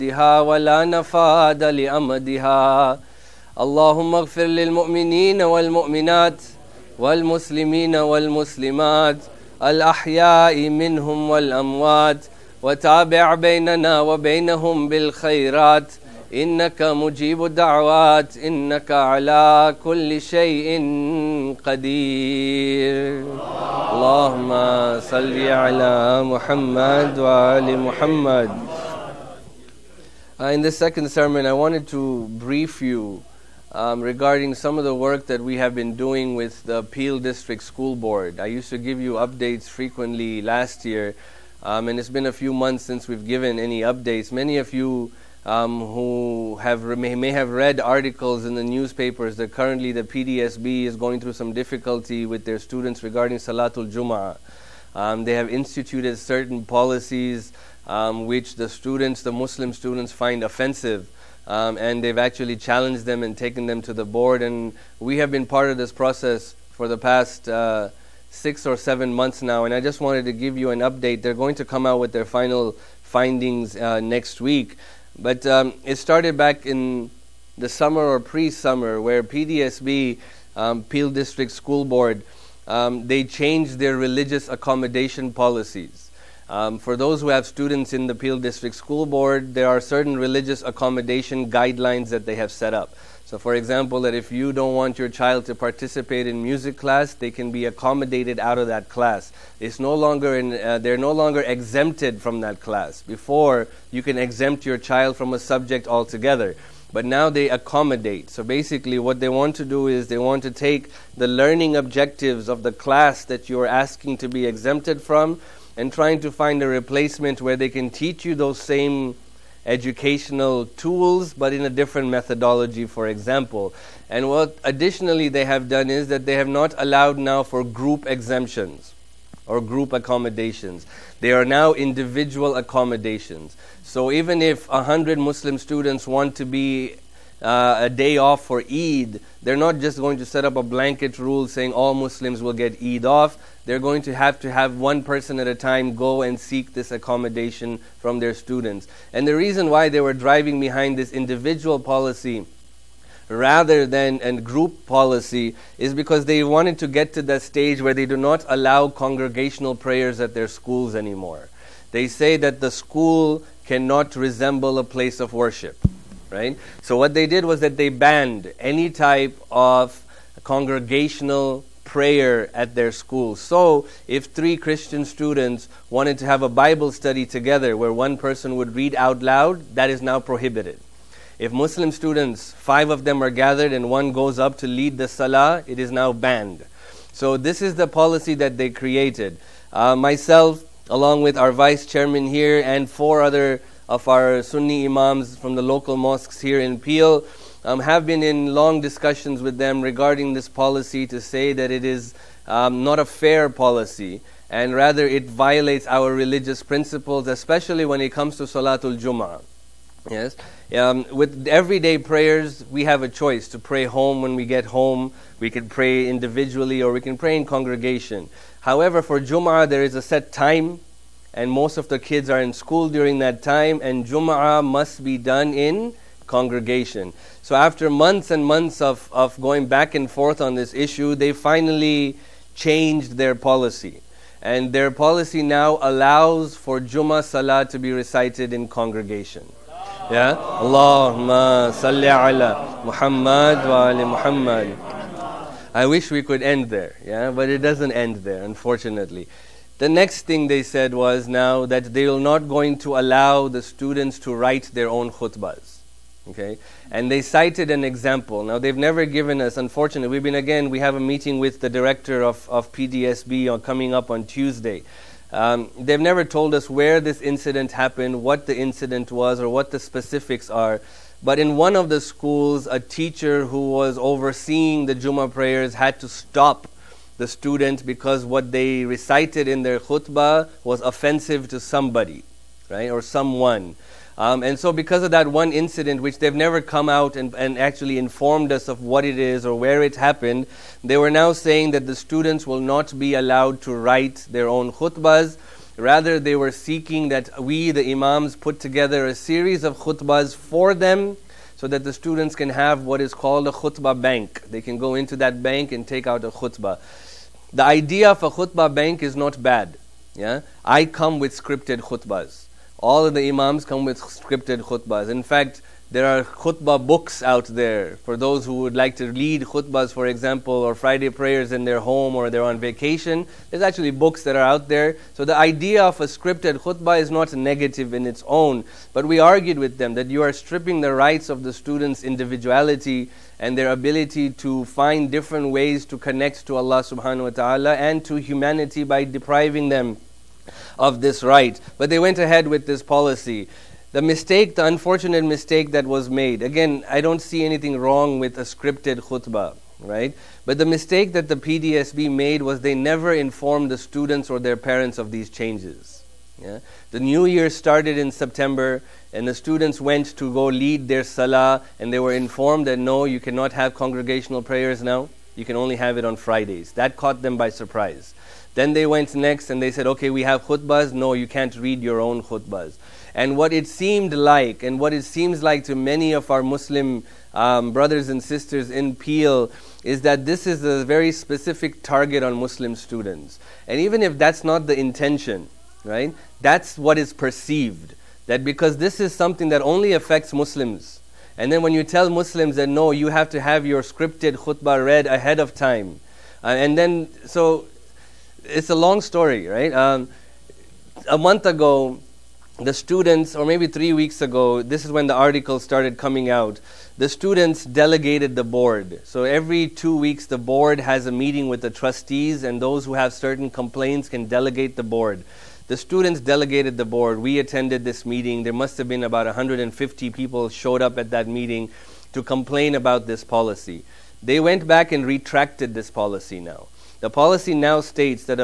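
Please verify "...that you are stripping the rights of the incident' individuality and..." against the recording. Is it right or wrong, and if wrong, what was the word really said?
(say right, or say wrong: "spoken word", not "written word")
wrong: "students", not "incident".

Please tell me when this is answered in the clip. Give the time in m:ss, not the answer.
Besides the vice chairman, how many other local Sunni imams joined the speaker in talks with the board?
3:12.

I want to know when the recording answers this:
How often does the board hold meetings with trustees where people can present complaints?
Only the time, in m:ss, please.
6:49.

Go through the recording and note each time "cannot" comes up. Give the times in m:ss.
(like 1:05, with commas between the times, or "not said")
2:43, 6:03.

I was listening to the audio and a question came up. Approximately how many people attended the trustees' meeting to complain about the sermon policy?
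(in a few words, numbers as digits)
150.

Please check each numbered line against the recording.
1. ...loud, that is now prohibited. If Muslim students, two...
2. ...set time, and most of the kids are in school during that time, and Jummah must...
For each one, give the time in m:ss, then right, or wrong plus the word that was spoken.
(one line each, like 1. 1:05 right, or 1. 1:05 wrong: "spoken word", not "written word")
1. 2:59 wrong: "five", not "two"
2. 3:40 right.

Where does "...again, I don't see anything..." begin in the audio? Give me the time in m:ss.
5:46.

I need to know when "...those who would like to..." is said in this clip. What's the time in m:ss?
5:18.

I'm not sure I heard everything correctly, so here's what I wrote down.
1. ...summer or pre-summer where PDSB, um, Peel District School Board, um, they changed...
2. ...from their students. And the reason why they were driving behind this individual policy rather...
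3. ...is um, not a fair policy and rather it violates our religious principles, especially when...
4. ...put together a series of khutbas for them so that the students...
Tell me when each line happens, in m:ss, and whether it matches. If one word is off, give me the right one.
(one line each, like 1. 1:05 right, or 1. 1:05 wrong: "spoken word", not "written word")
1. 1:17 right
2. 2:27 right
3. 3:21 right
4. 4:58 right.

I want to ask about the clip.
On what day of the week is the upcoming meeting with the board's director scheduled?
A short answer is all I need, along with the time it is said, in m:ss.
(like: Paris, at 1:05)
Tuesday, at 4:24.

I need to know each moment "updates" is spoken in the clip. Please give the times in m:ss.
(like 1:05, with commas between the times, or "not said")
0:39, 0:43, 1:10.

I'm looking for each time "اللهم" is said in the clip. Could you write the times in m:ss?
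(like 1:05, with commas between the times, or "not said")
0:03, 0:23.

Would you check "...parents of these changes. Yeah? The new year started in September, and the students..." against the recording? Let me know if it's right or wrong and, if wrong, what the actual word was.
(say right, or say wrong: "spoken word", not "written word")
right.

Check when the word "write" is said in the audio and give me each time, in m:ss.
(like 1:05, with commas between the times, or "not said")
4:14, 4:53.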